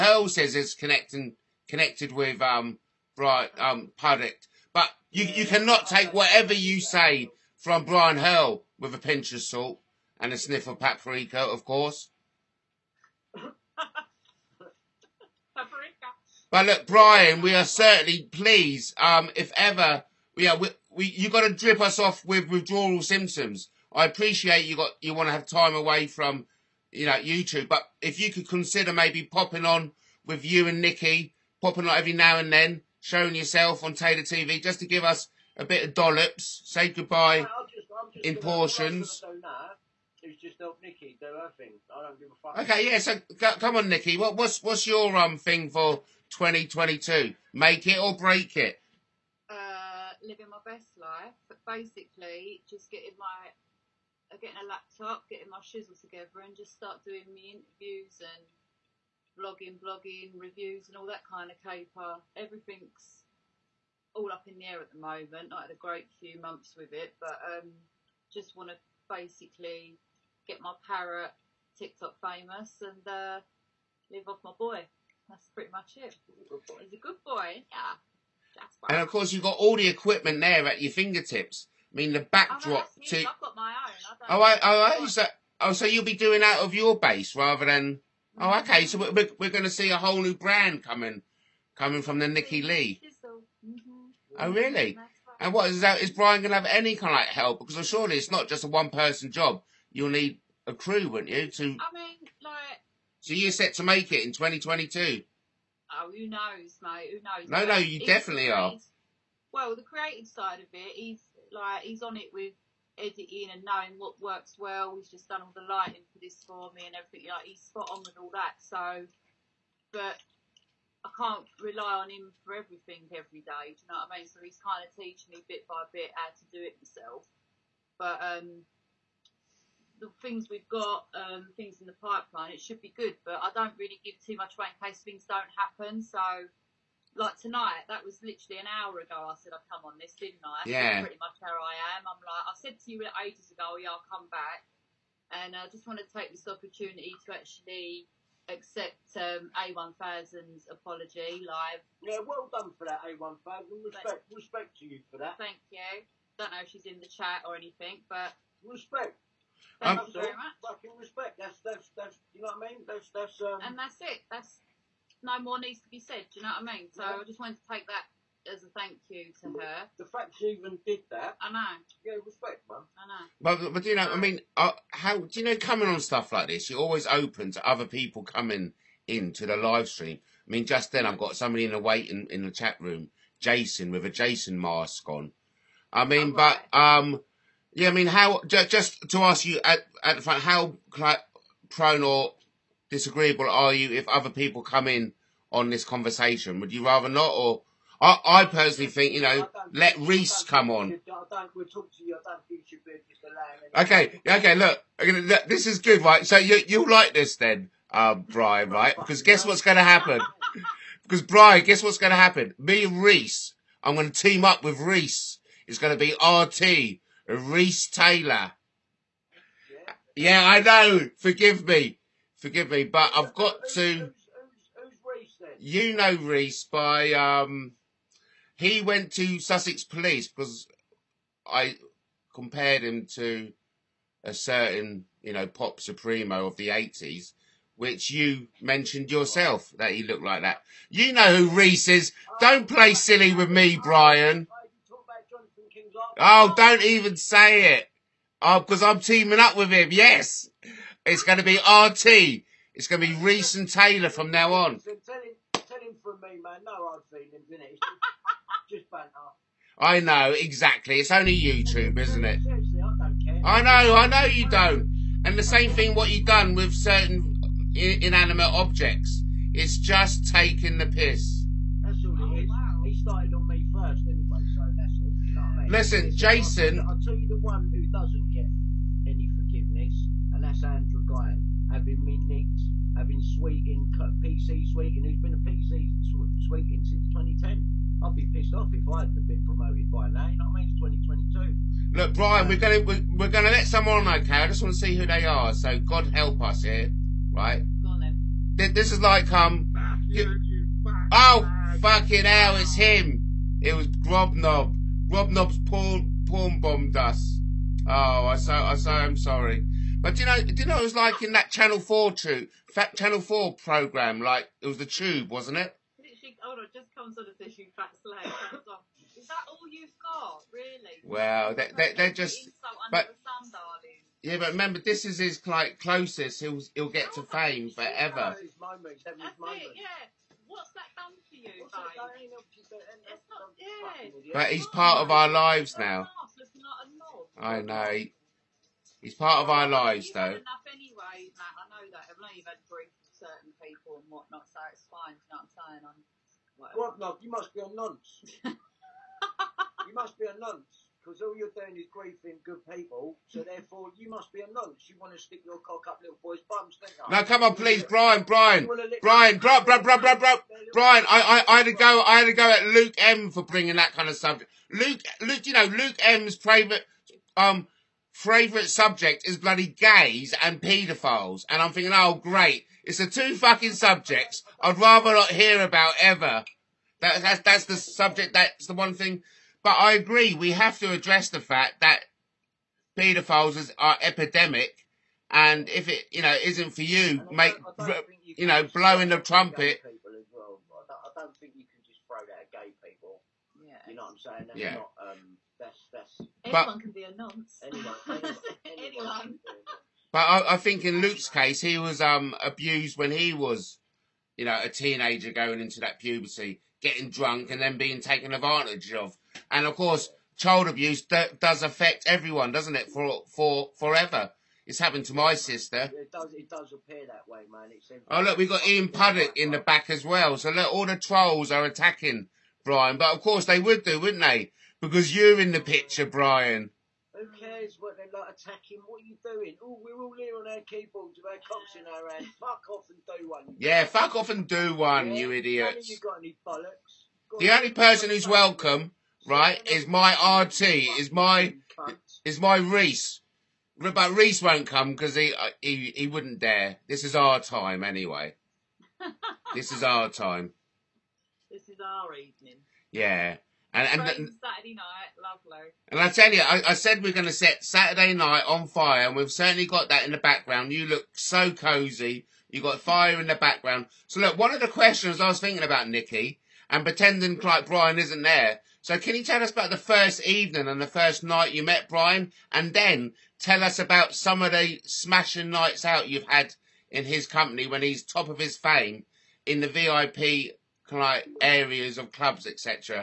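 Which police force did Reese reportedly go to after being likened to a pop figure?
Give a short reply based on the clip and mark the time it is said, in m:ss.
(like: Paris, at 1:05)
Sussex Police, at 3:49.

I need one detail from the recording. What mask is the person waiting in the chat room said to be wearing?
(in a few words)
A Jason mask.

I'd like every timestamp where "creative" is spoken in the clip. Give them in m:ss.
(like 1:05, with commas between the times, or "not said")
1:49.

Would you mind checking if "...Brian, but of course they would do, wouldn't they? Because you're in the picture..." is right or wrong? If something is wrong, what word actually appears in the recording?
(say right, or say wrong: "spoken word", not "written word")
right.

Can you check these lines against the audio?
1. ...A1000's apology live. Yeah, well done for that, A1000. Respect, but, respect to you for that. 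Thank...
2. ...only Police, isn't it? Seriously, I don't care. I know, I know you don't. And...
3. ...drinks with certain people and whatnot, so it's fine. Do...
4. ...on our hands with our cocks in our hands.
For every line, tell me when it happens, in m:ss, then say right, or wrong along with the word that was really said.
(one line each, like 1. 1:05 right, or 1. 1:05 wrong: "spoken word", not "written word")
1. 2:29 right
2. 4:21 wrong: "YouTube", not "Police"
3. 5:42 right
4. 7:10 wrong: "keyboards", not "hands".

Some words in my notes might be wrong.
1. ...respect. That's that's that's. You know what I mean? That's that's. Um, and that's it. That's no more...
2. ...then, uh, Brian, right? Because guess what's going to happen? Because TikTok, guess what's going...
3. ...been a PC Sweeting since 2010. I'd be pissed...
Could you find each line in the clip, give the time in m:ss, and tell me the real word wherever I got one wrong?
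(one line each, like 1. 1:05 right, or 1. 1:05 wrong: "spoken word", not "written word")
1. 2:40 right
2. 3:27 wrong: "Brian", not "TikTok"
3. 4:45 right.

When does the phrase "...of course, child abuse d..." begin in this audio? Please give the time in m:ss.
6:49.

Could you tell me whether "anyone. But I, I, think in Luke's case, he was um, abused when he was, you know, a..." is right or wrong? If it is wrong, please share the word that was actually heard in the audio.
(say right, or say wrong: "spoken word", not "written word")
right.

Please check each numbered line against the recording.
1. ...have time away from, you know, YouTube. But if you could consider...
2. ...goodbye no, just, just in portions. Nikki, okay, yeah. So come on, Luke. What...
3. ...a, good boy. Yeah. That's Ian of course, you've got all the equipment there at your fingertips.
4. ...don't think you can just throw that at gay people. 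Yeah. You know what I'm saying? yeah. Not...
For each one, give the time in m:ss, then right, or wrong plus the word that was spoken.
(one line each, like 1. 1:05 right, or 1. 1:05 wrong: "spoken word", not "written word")
1. 0:25 right
2. 0:36 wrong: "Nikki", not "Luke"
3. 1:16 wrong: "And", not "Ian"
4. 6:31 right.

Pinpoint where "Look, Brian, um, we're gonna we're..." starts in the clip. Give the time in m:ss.
4:51.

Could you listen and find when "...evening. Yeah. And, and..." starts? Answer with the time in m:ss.
7:32.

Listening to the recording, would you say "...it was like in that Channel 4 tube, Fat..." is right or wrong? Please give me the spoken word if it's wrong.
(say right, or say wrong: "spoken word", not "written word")
right.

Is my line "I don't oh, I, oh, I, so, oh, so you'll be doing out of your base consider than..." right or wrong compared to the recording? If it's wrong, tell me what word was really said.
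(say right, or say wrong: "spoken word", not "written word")
wrong: "rather", not "consider".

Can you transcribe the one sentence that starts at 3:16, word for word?
Would you rather not, or I, I personally think you know let Reese come on.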